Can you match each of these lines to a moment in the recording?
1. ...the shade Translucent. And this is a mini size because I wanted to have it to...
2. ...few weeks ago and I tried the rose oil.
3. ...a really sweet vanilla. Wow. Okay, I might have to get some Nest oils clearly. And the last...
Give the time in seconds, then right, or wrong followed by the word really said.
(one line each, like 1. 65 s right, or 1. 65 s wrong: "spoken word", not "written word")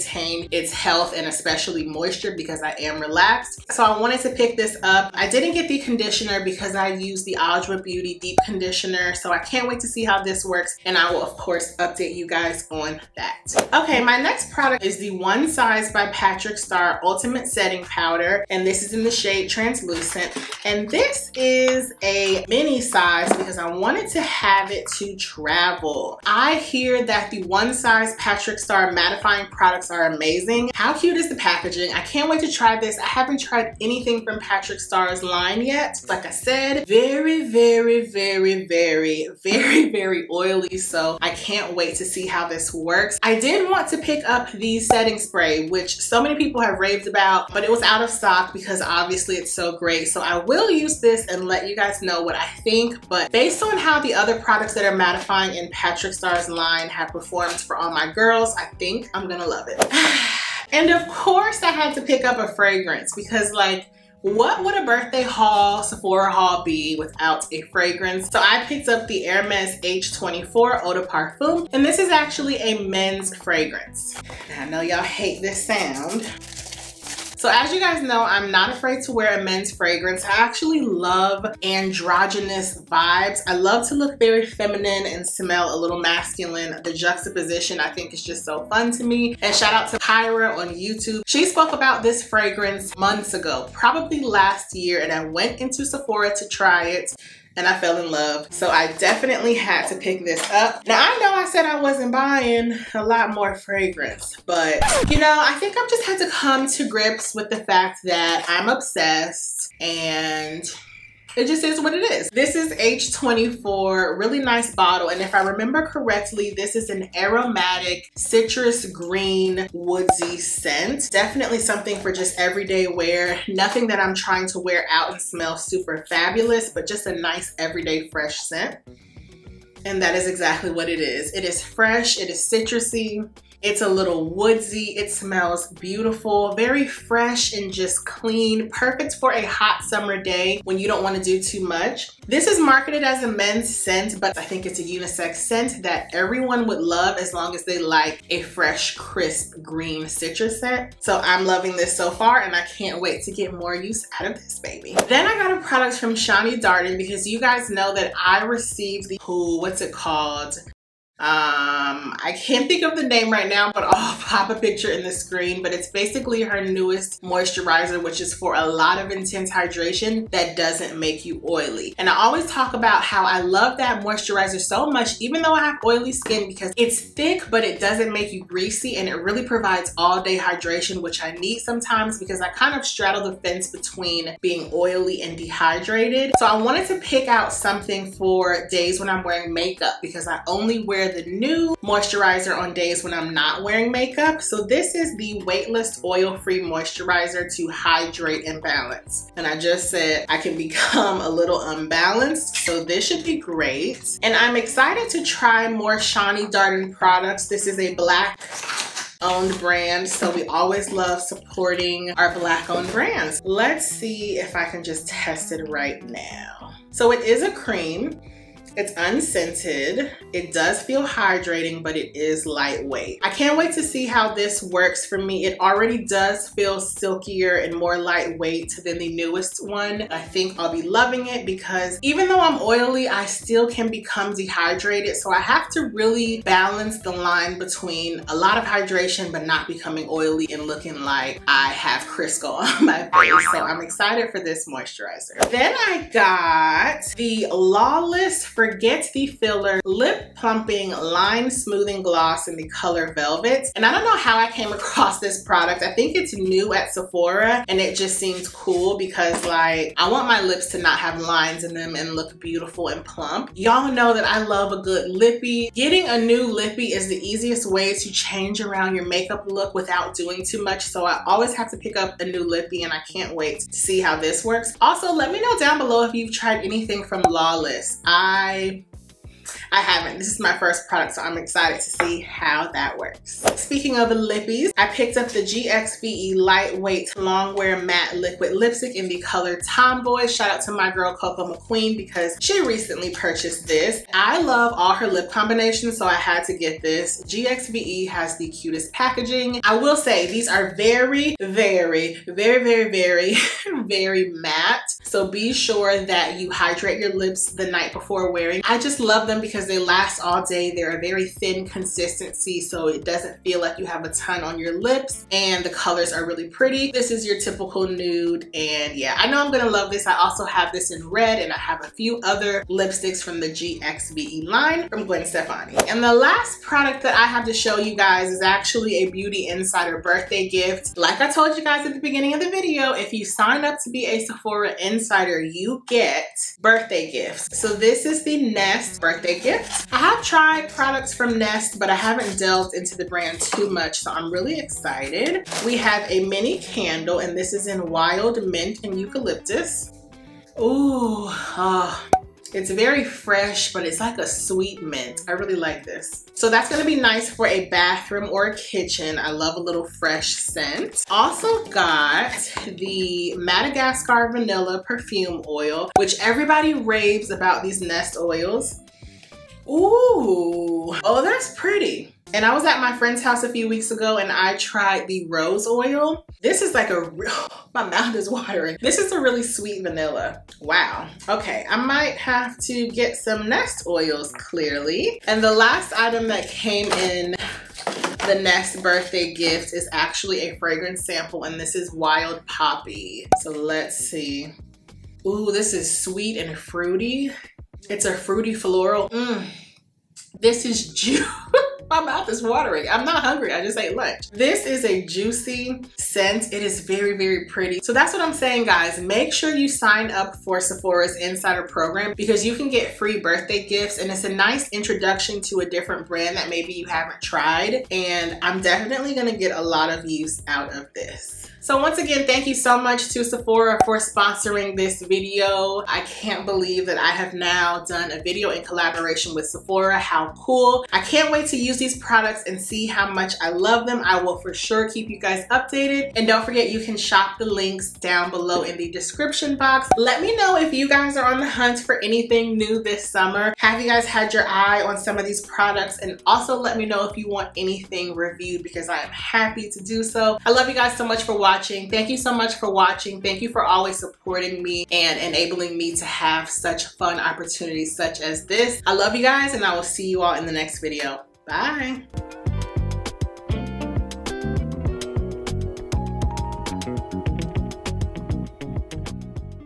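1. 19 s right
2. 373 s right
3. 379 s right.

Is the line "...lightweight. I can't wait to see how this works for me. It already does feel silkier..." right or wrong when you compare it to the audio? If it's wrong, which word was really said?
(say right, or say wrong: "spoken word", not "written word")
right.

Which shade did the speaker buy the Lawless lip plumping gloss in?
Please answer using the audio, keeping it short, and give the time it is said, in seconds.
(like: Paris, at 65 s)
Velvet, at 253 s.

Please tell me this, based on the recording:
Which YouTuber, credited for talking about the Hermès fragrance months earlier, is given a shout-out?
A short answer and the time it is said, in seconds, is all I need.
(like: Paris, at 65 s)
Kyra, at 89 s.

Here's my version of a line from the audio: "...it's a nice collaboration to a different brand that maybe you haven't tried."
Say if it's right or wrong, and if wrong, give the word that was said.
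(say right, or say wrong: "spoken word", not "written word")
wrong: "introduction", not "collaboration".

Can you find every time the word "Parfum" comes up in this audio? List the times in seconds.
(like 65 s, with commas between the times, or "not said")
71 s.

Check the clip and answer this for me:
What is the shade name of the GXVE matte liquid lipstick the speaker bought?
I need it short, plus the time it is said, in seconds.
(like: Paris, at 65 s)
Tomboy, at 289 s.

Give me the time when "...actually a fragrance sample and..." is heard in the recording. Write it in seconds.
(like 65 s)
389 s.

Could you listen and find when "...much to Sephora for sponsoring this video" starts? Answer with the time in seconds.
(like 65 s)
422 s.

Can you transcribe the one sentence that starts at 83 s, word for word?
I love to look very feminine and smell a little masculine.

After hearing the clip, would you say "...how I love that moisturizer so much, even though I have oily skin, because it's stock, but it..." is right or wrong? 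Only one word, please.
wrong.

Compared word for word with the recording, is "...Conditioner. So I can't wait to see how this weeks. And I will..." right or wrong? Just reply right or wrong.
wrong.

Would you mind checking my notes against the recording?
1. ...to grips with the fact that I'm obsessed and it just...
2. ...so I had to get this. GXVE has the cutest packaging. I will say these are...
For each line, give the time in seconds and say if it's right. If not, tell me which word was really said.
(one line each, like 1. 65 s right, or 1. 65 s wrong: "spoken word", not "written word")
1. 106 s right
2. 295 s right.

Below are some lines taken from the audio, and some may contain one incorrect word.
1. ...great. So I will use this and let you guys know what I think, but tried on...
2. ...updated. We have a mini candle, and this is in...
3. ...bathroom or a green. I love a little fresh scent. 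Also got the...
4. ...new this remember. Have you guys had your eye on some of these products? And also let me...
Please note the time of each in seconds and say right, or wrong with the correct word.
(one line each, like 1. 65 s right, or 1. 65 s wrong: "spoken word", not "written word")
1. 49 s wrong: "based", not "tried"
2. 344 s wrong: "excited", not "updated"
3. 357 s wrong: "kitchen", not "green"
4. 442 s wrong: "summer", not "remember".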